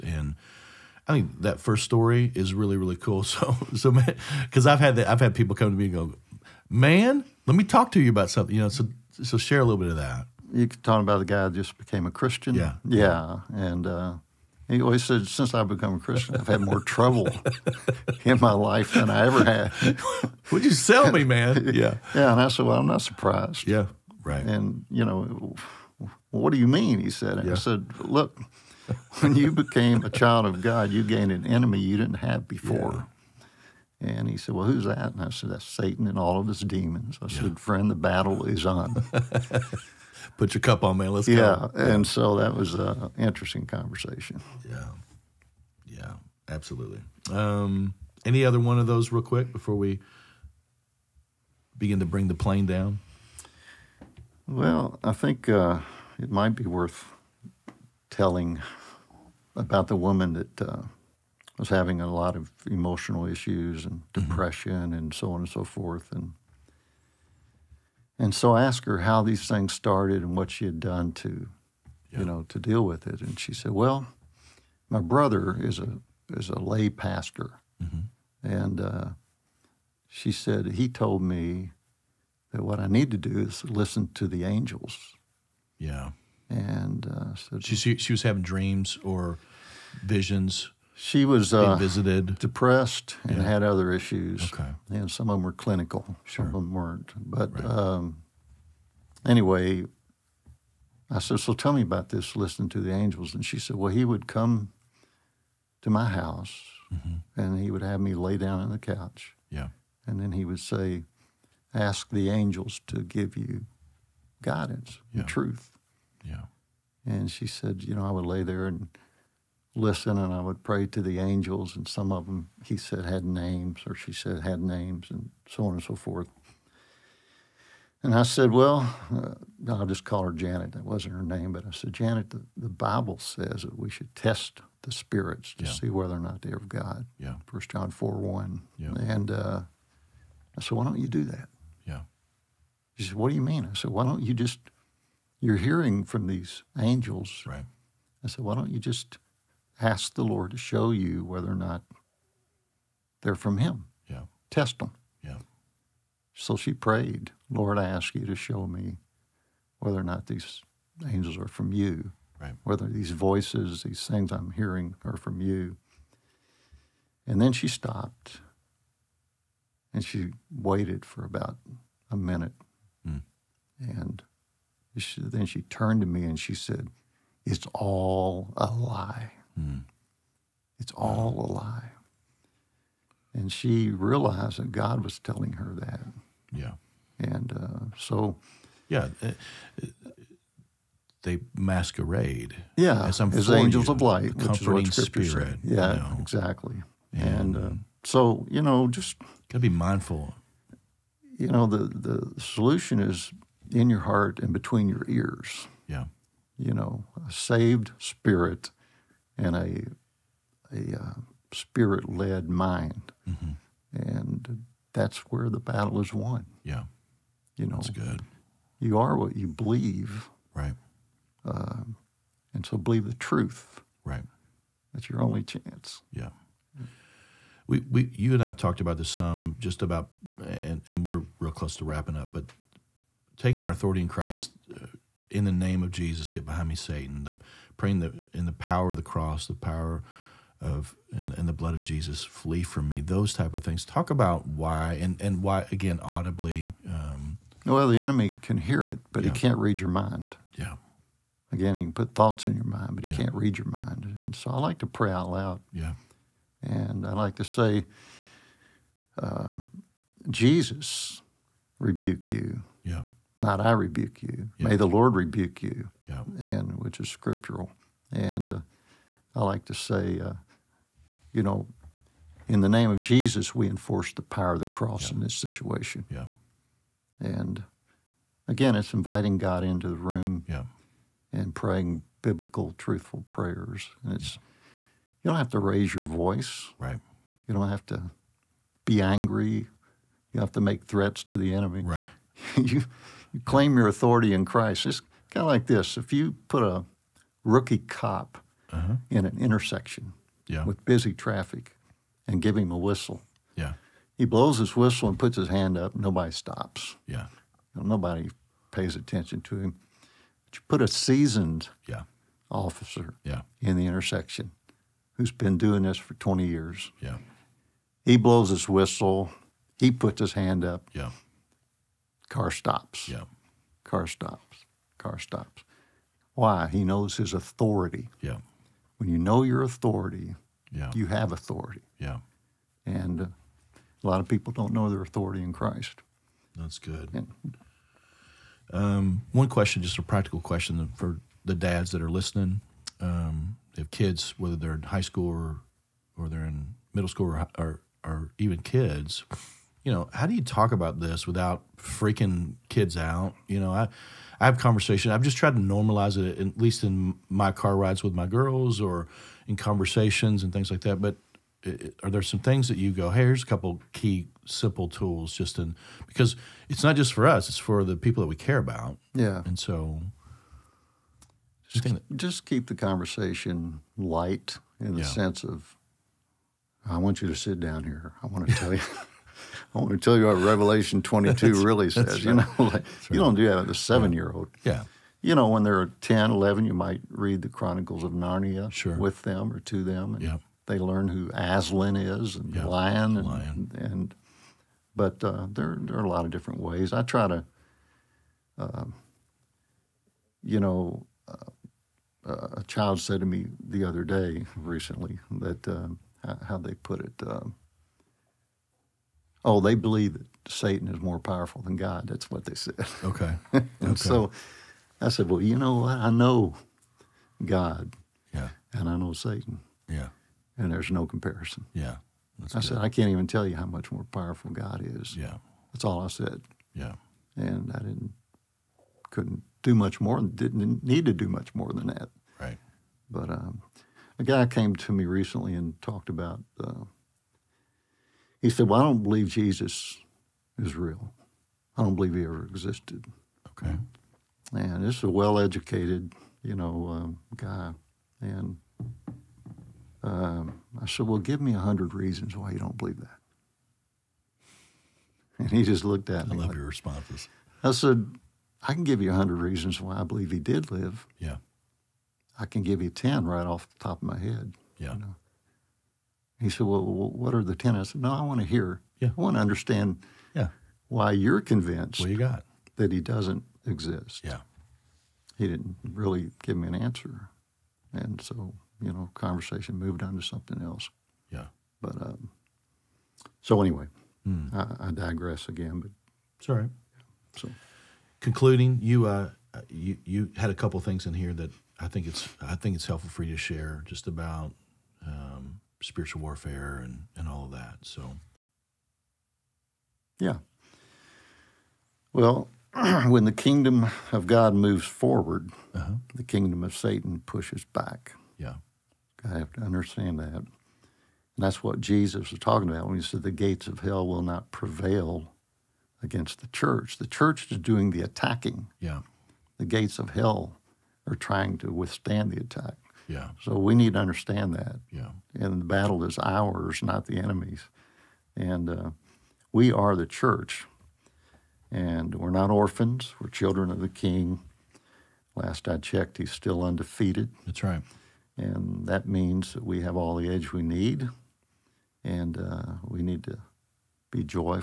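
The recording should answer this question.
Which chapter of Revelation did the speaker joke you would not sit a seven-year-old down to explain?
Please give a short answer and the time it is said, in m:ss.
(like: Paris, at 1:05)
Revelation 22, at 6:20.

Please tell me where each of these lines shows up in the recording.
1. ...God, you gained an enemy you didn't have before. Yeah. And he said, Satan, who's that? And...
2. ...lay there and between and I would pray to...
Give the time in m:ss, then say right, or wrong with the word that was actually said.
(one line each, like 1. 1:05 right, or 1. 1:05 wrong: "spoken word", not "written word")
1. 0:30 wrong: "Well", not "Satan"
2. 1:58 wrong: "listen", not "between".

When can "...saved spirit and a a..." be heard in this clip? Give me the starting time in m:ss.
3:27.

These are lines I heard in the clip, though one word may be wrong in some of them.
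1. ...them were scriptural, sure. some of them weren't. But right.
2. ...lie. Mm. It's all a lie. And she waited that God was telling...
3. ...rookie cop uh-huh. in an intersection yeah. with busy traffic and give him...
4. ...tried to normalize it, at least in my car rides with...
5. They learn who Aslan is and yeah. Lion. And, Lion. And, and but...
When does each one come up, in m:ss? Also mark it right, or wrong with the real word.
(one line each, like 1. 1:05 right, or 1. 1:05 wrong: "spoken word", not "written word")
1. 1:35 wrong: "clinical", not "scriptural"
2. 2:58 wrong: "realized", not "waited"
3. 4:57 right
4. 5:55 right
5. 6:30 right.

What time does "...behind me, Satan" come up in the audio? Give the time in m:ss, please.
3:56.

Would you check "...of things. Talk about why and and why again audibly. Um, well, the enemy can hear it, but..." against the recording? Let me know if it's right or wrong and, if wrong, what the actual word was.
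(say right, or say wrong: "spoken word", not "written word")
right.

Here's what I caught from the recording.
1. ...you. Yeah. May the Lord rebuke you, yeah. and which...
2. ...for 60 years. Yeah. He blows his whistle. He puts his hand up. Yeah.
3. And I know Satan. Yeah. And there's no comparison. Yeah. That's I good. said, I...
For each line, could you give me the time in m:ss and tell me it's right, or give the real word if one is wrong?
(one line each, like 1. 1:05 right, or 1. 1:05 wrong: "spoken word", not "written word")
1. 4:24 right
2. 5:15 wrong: "20", not "60"
3. 6:58 right.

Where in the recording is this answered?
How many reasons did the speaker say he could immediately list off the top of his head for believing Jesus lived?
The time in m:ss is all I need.
7:42.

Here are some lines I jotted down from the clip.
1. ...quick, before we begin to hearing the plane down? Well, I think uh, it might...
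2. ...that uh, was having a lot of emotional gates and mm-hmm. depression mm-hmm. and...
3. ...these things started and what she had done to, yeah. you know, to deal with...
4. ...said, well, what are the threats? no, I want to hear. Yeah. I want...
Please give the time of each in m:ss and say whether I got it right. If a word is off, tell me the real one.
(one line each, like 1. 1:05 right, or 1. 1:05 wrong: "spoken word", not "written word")
1. 0:49 wrong: "bring", not "hearing"
2. 1:00 wrong: "issues", not "gates"
3. 1:09 right
4. 7:46 wrong: "tenets", not "threats".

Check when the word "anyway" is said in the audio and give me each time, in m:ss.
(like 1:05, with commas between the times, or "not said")
1:39, 8:03.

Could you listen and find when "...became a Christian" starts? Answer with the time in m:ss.
0:11.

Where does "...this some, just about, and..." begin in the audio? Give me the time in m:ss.
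3:48.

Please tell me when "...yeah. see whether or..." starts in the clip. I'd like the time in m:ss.
2:15.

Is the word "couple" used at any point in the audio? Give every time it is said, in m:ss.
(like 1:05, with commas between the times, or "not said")
6:03, 8:10.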